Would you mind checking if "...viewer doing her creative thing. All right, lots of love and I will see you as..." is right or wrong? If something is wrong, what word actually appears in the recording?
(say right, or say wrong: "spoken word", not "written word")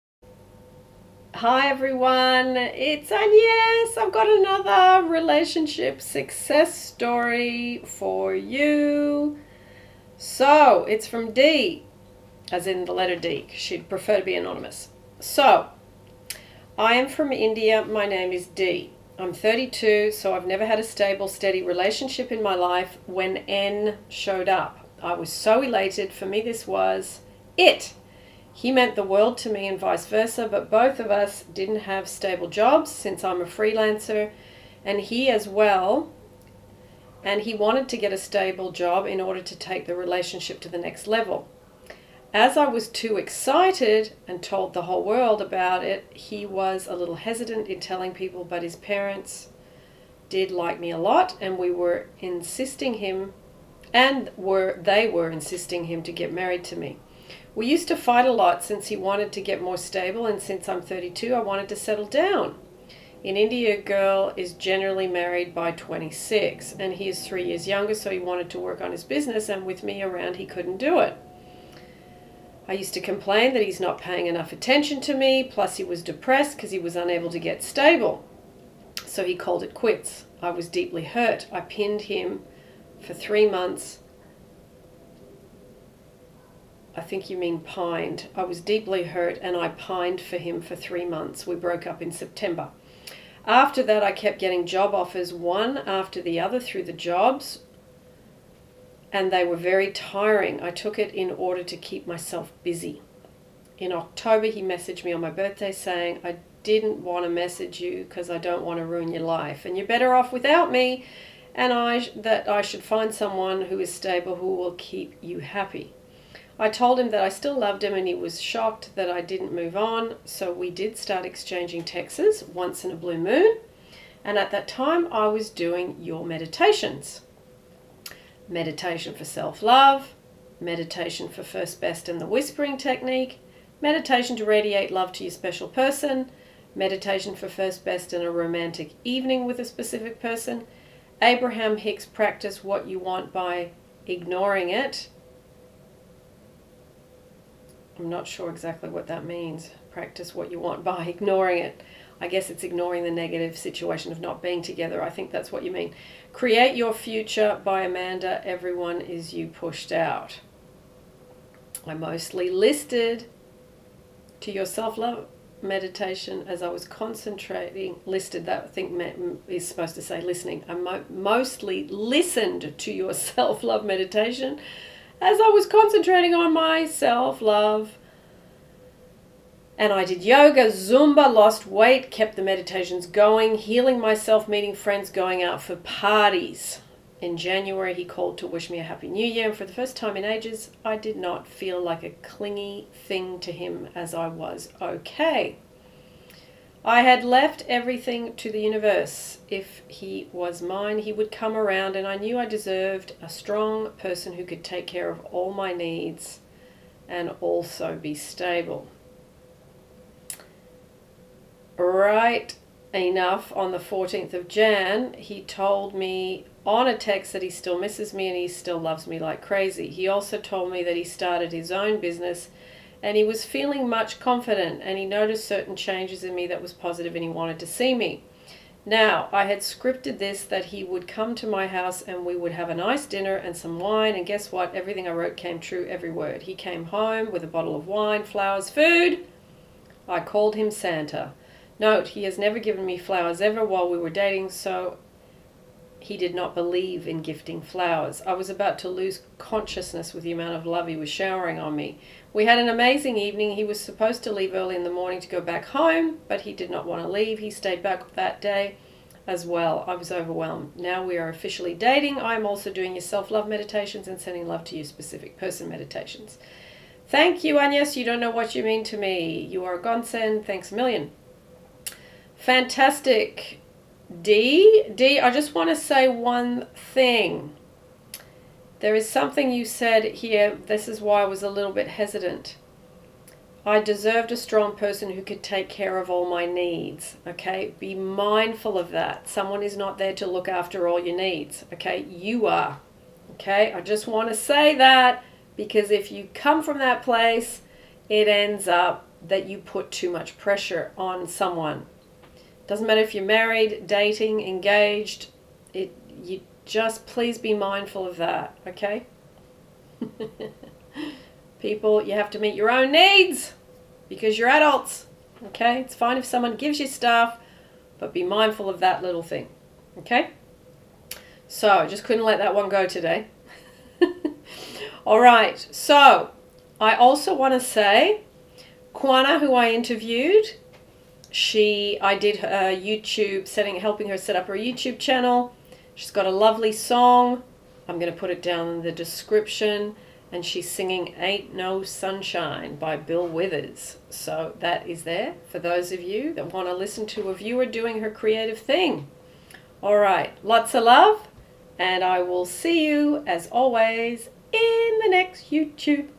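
right.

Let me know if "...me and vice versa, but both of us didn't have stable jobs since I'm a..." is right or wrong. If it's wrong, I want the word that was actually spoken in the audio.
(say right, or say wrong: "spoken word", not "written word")
right.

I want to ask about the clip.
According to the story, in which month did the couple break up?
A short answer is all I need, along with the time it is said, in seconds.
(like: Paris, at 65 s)
September, at 92 s.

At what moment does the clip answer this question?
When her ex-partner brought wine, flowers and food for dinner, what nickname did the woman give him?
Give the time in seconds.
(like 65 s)
240 s.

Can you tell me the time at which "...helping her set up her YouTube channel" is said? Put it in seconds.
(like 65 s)
333 s.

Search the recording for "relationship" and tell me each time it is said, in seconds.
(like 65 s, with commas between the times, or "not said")
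5 s, 21 s, 39 s.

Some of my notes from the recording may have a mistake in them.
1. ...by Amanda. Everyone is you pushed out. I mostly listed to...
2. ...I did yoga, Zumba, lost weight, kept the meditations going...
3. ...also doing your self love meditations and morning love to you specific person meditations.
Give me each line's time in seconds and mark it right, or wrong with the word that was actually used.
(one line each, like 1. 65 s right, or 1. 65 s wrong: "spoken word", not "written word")
1. 157 s right
2. 179 s right
3. 262 s wrong: "sending", not "morning".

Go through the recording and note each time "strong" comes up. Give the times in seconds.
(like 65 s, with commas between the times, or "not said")
203 s, 284 s.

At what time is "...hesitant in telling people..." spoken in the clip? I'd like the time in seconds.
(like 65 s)
47 s.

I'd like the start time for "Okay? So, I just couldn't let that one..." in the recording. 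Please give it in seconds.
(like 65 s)
319 s.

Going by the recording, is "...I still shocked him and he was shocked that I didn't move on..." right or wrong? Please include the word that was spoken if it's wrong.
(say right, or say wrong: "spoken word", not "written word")
wrong: "loved", not "shocked".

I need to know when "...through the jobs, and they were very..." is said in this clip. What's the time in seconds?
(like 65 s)
96 s.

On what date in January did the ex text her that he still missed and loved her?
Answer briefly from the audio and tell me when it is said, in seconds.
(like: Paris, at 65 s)
14th of January, at 213 s.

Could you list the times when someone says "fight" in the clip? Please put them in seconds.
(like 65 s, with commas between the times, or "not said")
57 s.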